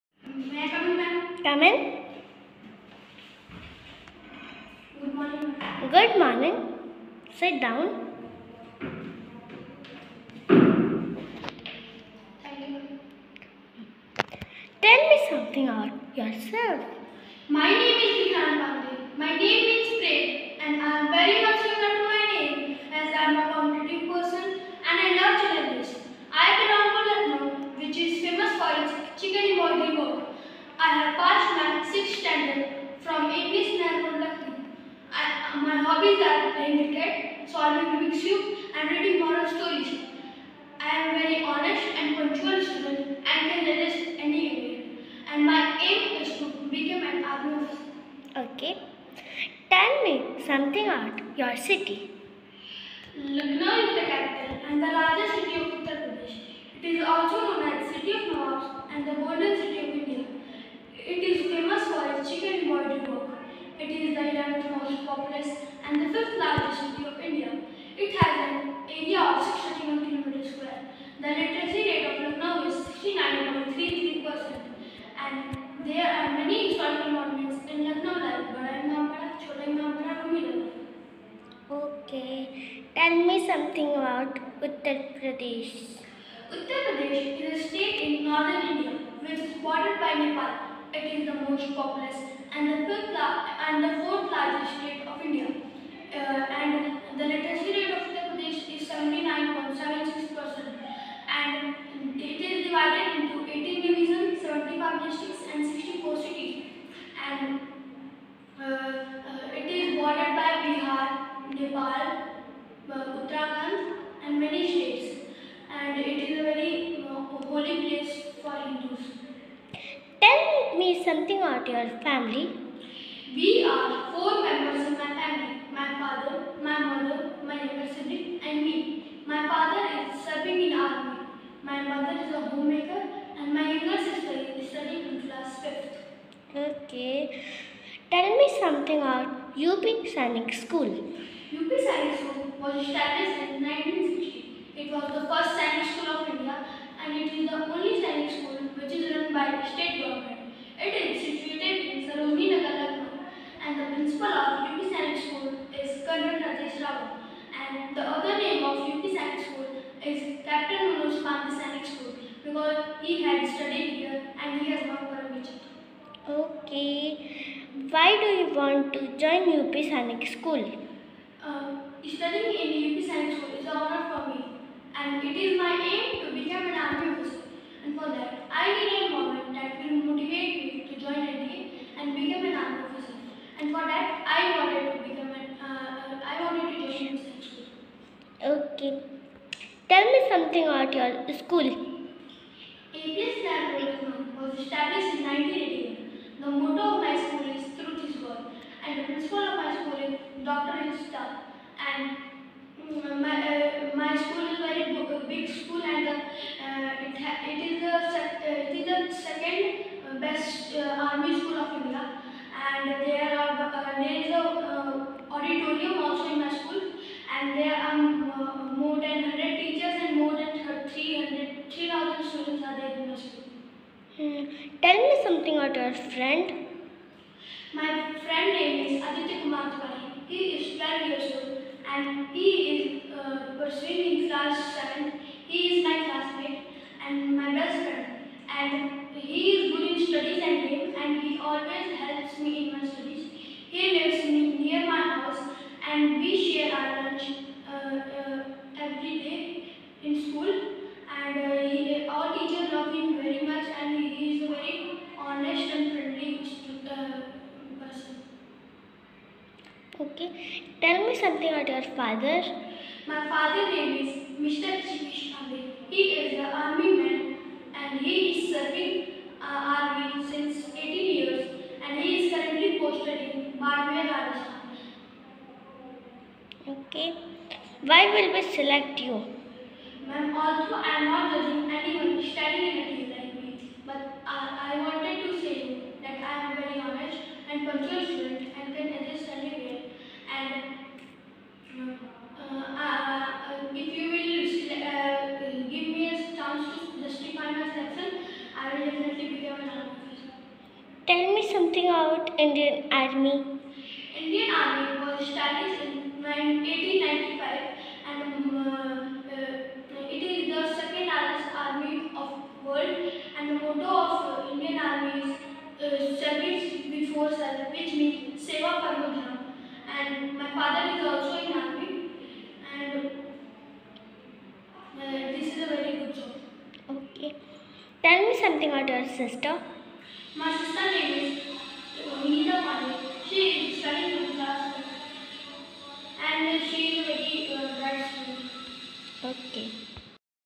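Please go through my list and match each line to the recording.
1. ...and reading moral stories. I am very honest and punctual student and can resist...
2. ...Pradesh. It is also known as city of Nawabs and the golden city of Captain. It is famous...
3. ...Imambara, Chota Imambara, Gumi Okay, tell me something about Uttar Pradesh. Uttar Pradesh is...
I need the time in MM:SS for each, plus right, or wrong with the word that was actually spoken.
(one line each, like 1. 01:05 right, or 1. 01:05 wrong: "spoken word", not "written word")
1. 00:38 right
2. 00:56 wrong: "India", not "Captain"
3. 01:18 right.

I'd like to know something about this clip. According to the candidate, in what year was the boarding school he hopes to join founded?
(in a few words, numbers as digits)
1960.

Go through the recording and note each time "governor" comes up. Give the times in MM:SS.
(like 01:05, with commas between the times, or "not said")
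not said.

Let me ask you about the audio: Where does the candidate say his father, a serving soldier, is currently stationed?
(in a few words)
Barmer, Rajasthan.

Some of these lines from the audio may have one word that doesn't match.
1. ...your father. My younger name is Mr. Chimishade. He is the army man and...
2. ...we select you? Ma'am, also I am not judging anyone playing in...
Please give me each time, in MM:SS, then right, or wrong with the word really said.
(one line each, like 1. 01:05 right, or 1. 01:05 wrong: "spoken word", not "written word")
1. 04:21 wrong: "father", not "younger"
2. 04:38 wrong: "standing", not "playing".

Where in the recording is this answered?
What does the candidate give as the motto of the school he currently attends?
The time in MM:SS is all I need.
03:17.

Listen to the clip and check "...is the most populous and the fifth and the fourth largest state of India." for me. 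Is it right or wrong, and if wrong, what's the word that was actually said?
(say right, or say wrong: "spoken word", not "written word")
right.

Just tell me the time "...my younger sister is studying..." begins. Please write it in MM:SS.
02:13.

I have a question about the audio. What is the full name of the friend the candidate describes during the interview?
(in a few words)
Aditya Kumar Tiwari.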